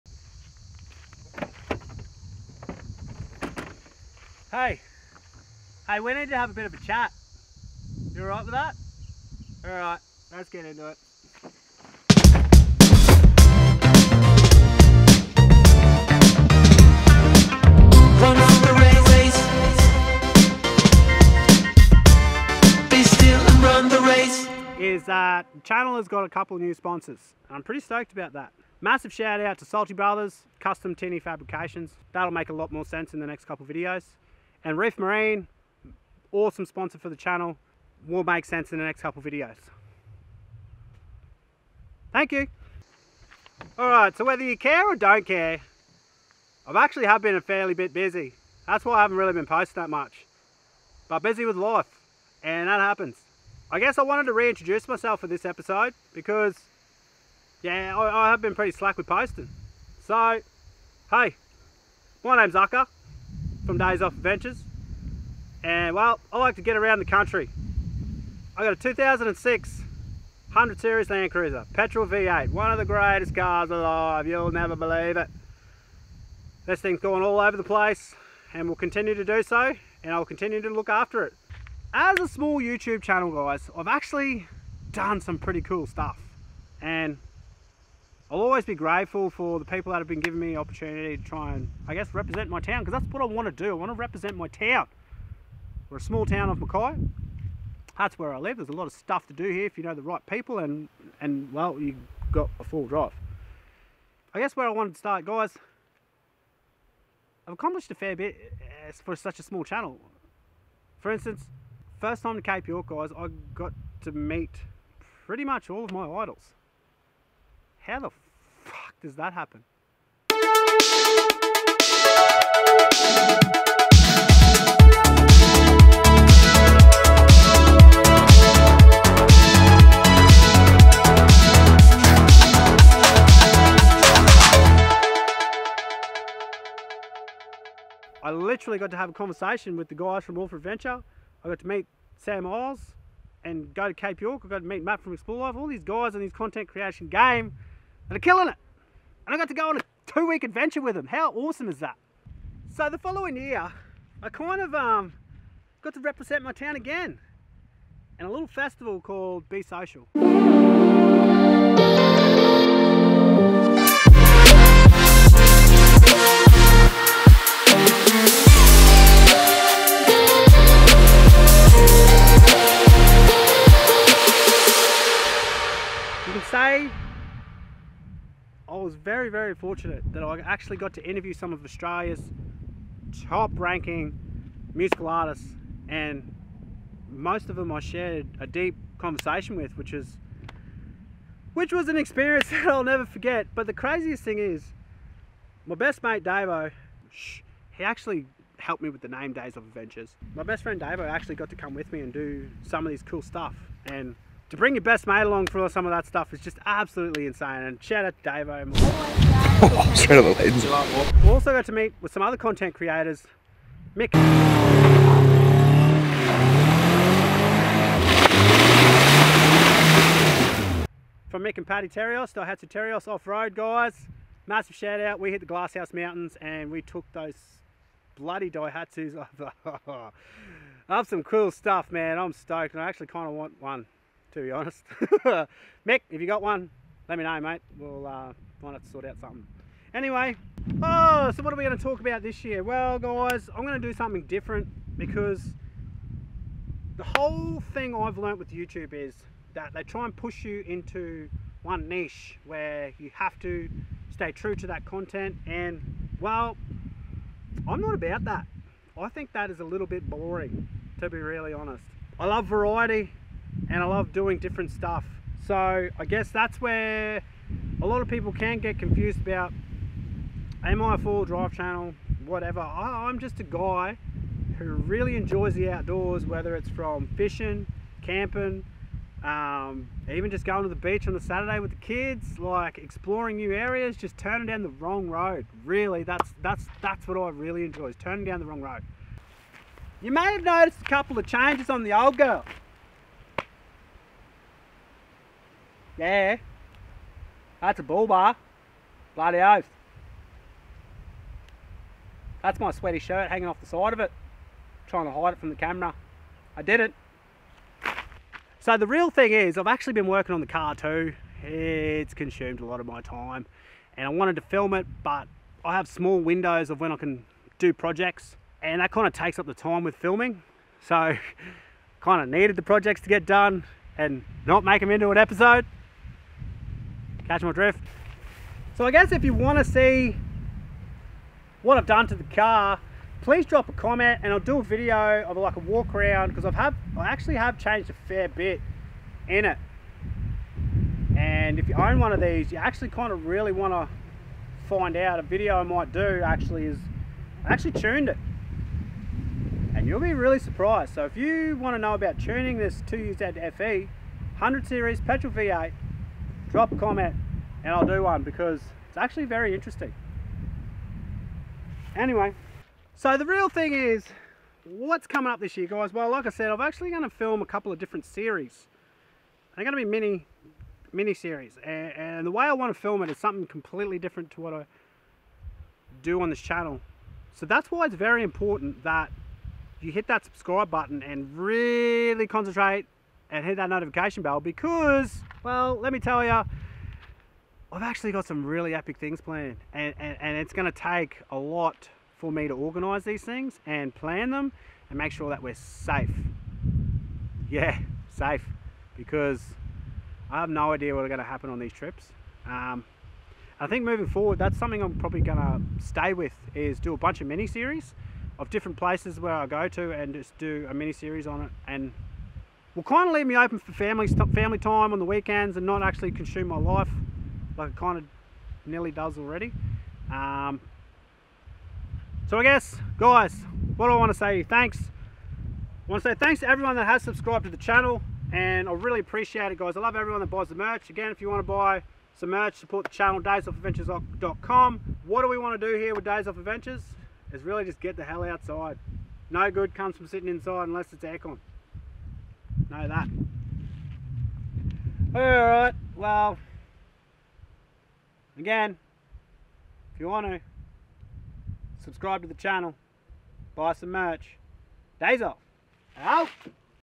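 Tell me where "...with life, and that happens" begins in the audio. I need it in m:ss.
0:51.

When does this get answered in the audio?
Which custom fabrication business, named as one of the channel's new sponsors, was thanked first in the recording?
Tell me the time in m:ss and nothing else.
0:29.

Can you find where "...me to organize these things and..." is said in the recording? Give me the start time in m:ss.
6:32.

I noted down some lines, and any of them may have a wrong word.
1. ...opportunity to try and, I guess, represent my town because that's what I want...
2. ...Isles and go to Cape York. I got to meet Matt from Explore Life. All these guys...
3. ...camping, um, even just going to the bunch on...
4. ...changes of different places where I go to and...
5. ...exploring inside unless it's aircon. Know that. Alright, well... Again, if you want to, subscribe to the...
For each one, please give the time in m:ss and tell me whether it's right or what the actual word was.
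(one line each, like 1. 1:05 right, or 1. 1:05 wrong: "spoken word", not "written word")
1. 1:30 right
2. 2:22 right
3. 4:38 wrong: "beach", not "bunch"
4. 6:47 wrong: "series", not "changes"
5. 7:20 wrong: "sitting", not "exploring".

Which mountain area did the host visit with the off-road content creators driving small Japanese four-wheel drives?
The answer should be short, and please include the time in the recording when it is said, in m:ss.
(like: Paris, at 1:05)
Glasshouse Mountains, at 3:45.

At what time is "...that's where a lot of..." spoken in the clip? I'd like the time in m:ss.
4:26.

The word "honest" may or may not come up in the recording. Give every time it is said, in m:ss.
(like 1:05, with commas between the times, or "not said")
3:54, 4:21.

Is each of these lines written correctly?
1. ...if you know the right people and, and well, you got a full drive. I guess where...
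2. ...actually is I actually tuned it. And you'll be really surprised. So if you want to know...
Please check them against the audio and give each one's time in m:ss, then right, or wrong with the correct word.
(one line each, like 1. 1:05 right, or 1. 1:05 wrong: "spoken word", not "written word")
1. 1:39 right
2. 5:46 right.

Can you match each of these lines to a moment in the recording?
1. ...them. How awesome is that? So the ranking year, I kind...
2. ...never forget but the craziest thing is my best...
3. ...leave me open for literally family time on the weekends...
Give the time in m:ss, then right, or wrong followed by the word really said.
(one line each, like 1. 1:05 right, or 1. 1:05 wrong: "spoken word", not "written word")
1. 2:30 wrong: "following", not "ranking"
2. 3:12 right
3. 6:53 wrong: "family", not "literally".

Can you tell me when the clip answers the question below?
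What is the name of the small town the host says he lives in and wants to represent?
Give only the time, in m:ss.
1:36.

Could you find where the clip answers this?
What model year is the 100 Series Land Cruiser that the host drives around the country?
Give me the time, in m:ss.
1:08.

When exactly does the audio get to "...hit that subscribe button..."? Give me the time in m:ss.
6:19.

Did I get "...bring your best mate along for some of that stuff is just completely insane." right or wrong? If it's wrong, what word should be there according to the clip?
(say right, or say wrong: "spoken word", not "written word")
wrong: "absolutely", not "completely".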